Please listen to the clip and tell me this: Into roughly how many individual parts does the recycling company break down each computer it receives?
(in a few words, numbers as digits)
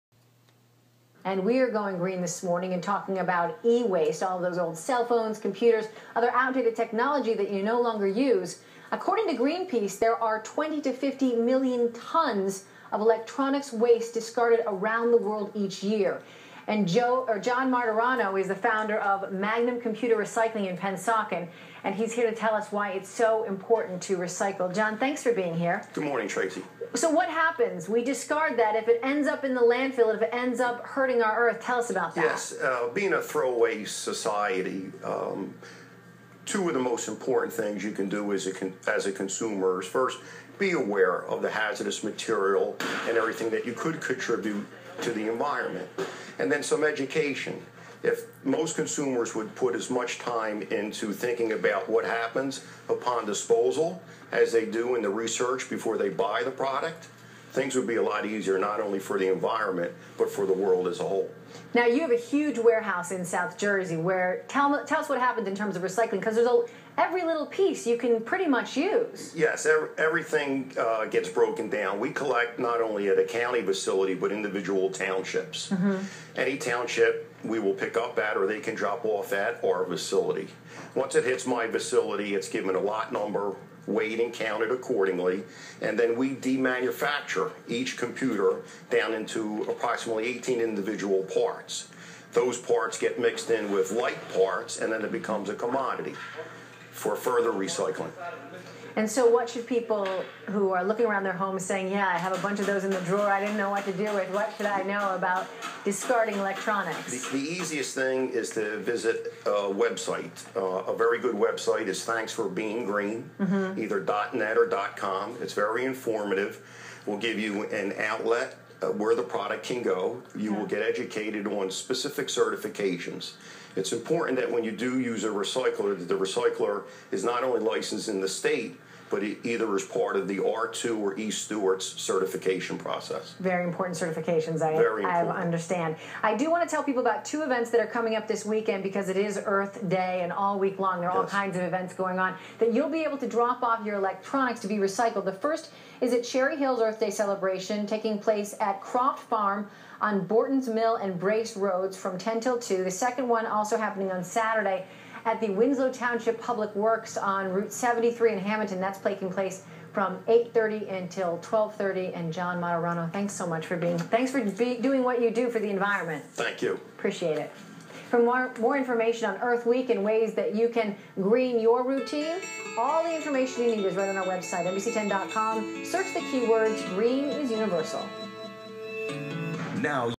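18.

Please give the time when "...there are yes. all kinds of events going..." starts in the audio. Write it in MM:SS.
02:21.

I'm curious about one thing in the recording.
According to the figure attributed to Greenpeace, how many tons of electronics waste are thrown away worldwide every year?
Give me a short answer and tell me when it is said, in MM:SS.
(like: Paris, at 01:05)
20 to 50 million, at 00:10.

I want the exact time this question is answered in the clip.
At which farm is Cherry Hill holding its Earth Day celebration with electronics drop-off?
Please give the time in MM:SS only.
02:28.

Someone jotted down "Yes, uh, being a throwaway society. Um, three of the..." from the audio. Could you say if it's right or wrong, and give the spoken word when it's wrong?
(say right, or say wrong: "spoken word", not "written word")
wrong: "two", not "three".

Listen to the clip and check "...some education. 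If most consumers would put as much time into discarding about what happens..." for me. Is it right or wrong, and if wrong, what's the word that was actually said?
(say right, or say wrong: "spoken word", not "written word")
wrong: "thinking", not "discarding".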